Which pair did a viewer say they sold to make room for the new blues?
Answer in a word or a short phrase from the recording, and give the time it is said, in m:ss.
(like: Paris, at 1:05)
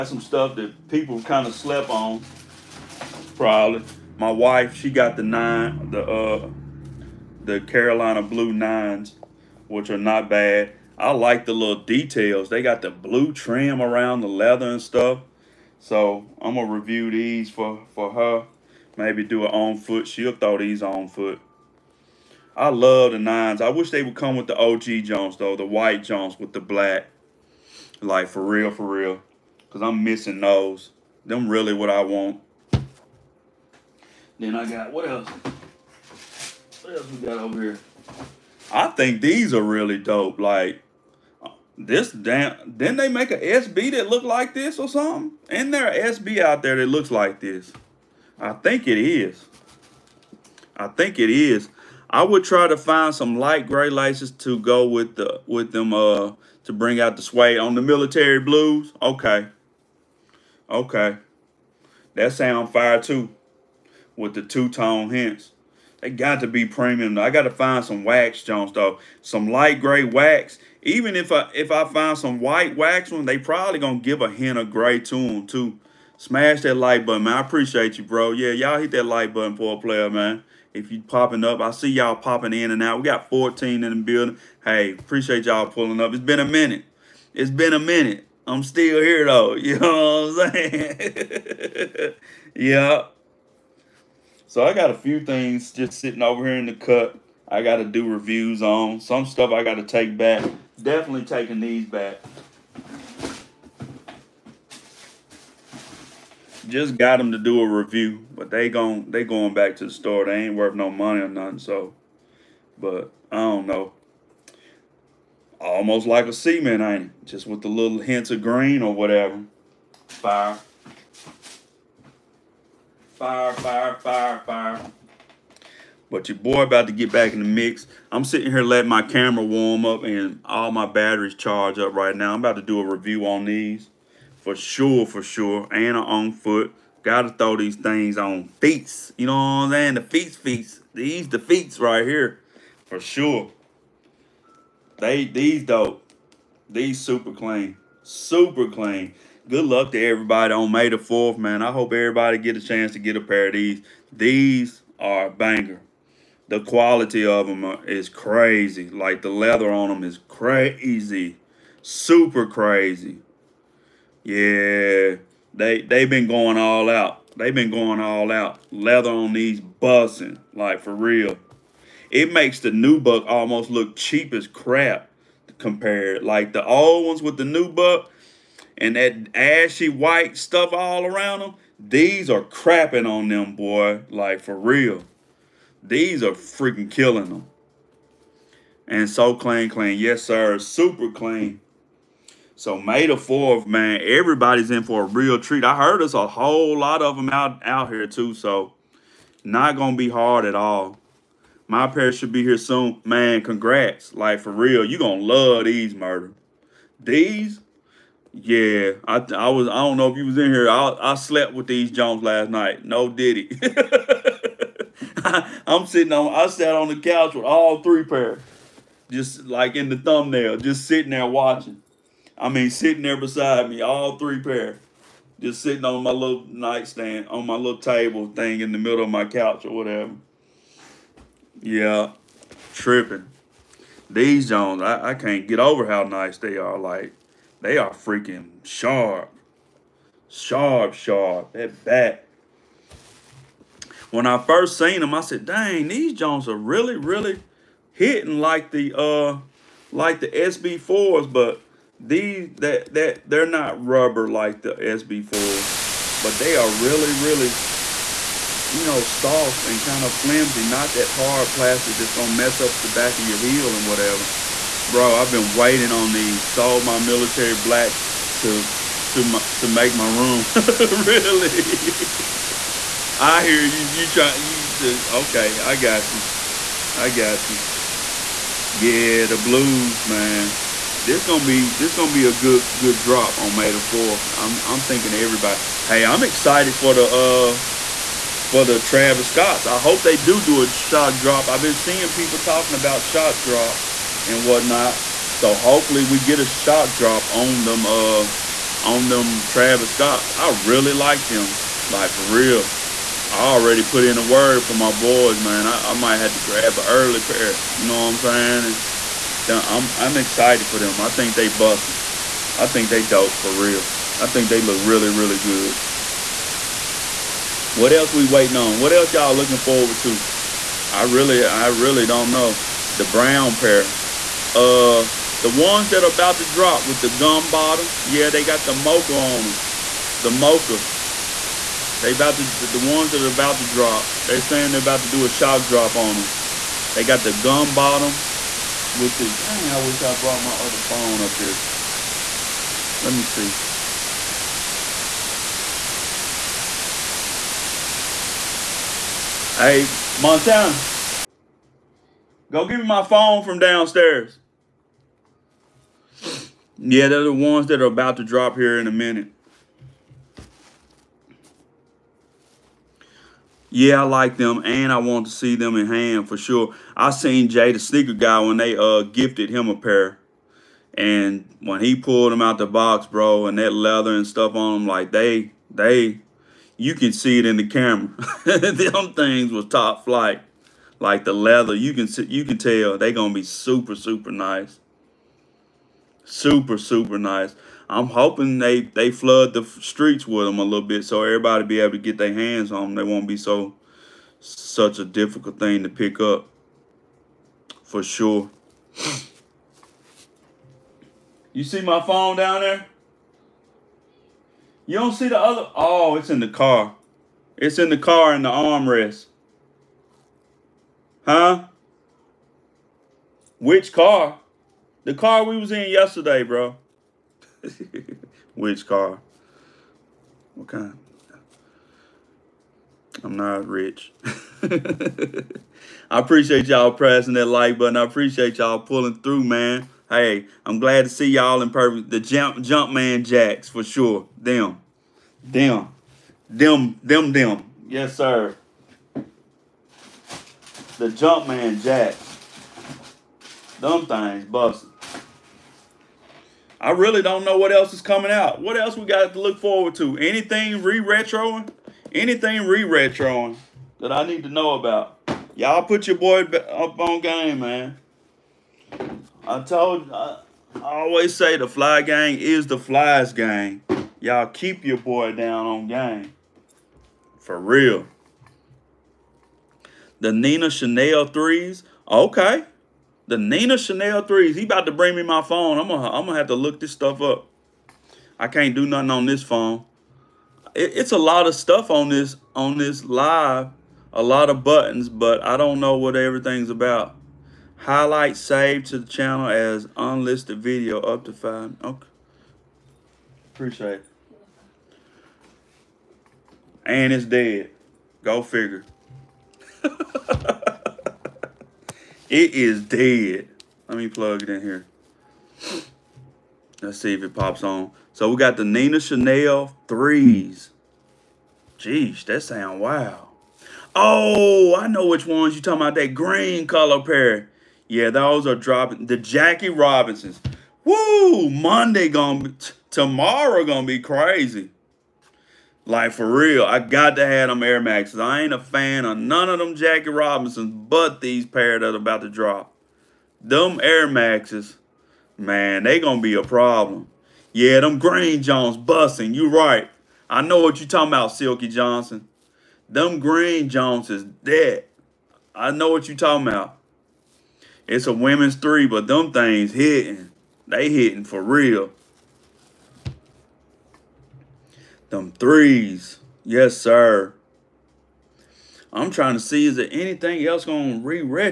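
military blacks, at 4:26.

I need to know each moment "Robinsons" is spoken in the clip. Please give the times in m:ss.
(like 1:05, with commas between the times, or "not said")
8:39, 8:50.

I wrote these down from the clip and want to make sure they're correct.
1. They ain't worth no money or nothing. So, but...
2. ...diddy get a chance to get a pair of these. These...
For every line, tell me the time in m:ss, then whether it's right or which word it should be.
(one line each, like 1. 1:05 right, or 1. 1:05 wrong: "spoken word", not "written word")
1. 1:50 right
2. 2:31 wrong: "everybody", not "diddy".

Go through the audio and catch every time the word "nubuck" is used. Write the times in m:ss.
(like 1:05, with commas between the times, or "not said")
2:52, 2:57.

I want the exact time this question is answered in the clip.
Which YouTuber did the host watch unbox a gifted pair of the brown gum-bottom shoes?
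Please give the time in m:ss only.
6:07.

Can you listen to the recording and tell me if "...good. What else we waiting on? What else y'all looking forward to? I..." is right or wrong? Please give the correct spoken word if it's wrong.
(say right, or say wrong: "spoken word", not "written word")
right.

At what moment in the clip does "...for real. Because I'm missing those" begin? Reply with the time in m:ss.
0:28.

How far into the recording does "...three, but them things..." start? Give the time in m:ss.
9:08.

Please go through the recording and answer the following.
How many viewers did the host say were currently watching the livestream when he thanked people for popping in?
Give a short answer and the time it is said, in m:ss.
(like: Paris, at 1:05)
14, at 1:23.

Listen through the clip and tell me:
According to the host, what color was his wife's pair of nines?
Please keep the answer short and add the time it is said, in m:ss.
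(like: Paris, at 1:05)
Carolina blue, at 0:07.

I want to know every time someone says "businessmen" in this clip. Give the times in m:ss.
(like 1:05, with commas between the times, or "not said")
not said.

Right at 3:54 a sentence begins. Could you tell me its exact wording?
These Jones, I, I can't get over how nice they are.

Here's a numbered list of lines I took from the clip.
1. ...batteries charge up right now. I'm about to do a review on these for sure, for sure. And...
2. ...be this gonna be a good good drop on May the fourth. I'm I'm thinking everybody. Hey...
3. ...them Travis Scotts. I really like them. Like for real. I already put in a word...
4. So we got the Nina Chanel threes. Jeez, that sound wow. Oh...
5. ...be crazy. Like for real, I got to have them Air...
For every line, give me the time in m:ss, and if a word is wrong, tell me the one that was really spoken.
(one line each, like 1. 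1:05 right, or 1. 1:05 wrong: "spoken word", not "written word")
1. 2:10 right
2. 4:41 right
3. 4:59 right
4. 8:28 right
5. 8:43 right.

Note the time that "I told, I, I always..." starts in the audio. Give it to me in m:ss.
7:39.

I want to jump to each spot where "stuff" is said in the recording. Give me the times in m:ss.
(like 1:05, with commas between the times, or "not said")
0:00, 0:14, 1:39, 3:00, 6:14, 7:56, 8:01.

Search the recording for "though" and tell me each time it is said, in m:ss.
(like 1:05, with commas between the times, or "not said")
0:25, 1:08, 1:29.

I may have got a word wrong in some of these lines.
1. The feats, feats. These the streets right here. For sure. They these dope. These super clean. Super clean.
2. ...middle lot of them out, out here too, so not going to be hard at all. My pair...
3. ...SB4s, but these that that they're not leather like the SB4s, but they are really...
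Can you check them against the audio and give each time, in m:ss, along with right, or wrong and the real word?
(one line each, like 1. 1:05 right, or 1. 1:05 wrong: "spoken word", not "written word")
1. 2:19 wrong: "feats", not "streets"
2. 3:16 wrong: "whole", not "middle"
3. 4:10 wrong: "rubber", not "leather".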